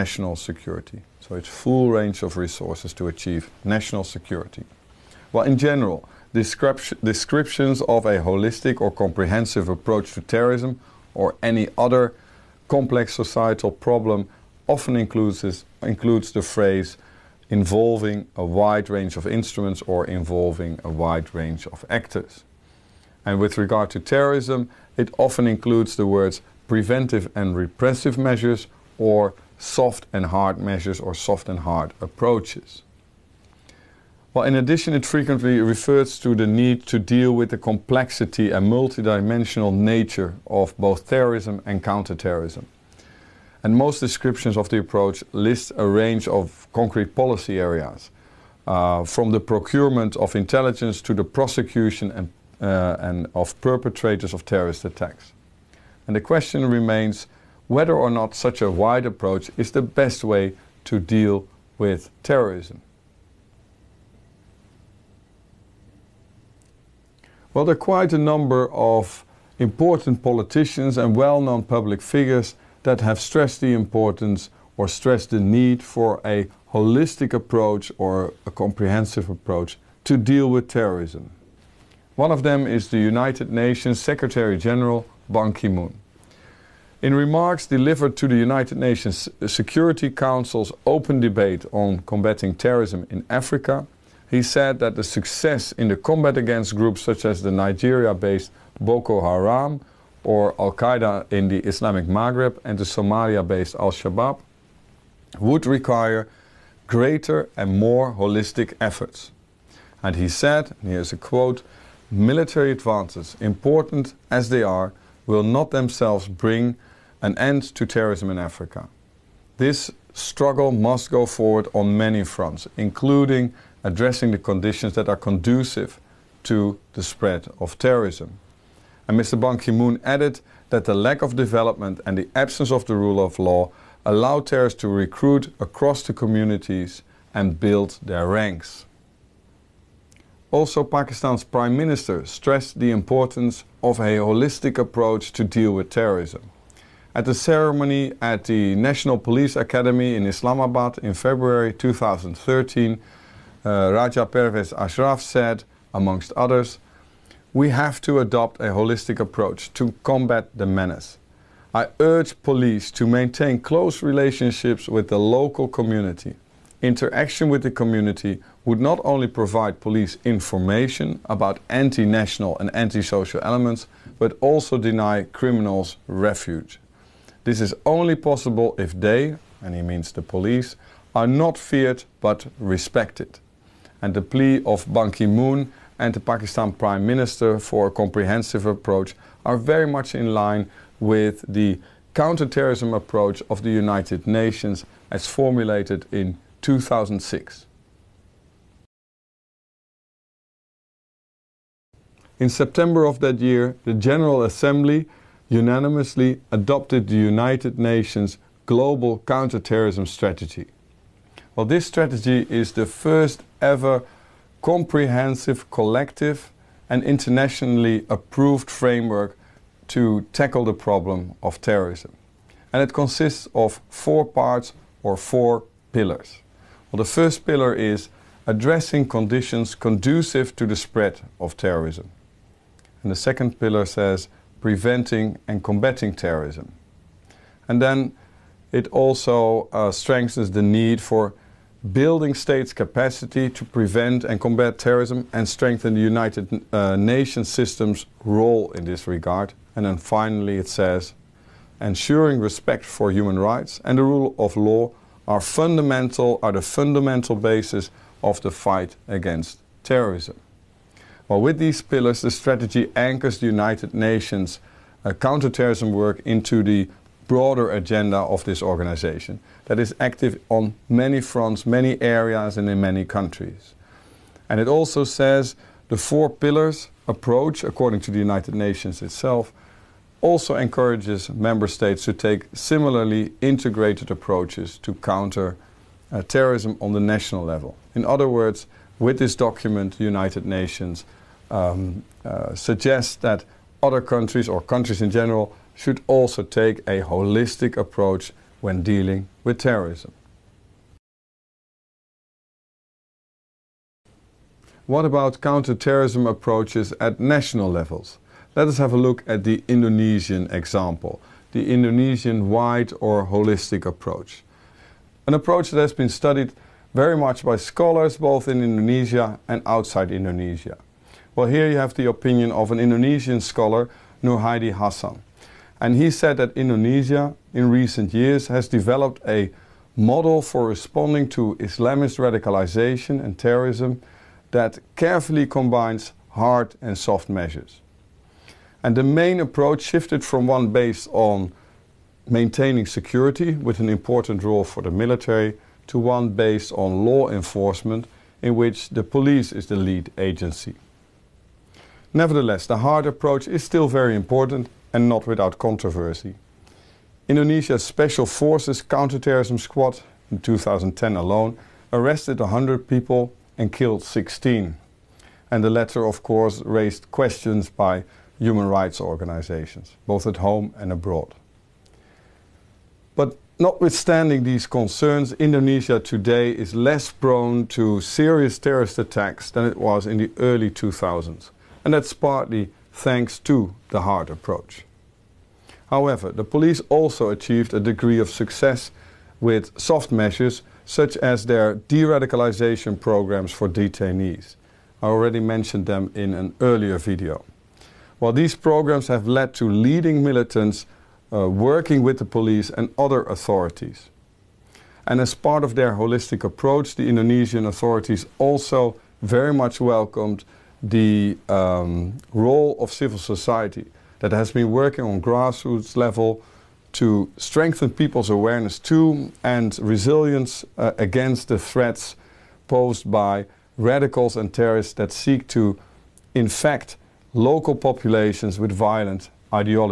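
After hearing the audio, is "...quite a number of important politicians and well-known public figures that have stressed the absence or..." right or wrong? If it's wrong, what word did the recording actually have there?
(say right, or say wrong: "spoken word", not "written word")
wrong: "importance", not "absence".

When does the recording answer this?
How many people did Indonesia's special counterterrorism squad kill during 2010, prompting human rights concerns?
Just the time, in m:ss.
6:04.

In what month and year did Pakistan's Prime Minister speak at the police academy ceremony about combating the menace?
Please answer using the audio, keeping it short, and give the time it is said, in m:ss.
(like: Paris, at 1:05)
February 2013, at 2:31.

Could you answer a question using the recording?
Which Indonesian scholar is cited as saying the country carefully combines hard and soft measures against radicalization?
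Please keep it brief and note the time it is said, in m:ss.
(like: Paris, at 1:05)
Noorhaidi Hasan, at 5:24.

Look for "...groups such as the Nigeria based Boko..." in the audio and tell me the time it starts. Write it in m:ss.
1:36.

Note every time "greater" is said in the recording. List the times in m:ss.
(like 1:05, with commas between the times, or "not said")
1:46.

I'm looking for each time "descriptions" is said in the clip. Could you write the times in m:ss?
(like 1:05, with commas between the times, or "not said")
0:06, 0:43.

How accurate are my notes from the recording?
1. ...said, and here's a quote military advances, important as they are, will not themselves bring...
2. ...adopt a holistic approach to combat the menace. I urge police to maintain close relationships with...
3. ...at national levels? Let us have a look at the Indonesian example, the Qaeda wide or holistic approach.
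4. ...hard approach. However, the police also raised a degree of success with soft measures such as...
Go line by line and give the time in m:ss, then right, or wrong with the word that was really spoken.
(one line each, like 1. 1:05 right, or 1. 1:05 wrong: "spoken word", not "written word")
1. 1:50 right
2. 2:38 right
3. 5:06 wrong: "Indonesian", not "Qaeda"
4. 6:24 wrong: "achieved", not "raised".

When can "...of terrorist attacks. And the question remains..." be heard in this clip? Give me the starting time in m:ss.
0:54.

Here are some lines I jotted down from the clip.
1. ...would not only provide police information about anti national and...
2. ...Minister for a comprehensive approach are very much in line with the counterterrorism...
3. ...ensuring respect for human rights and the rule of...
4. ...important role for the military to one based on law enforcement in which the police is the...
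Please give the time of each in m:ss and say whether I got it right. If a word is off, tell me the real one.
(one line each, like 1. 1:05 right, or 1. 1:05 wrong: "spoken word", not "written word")
1. 2:48 right
2. 3:07 right
3. 4:11 right
4. 5:43 right.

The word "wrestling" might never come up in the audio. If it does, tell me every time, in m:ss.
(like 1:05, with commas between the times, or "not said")
not said.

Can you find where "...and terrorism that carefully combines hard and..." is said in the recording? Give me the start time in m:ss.
5:33.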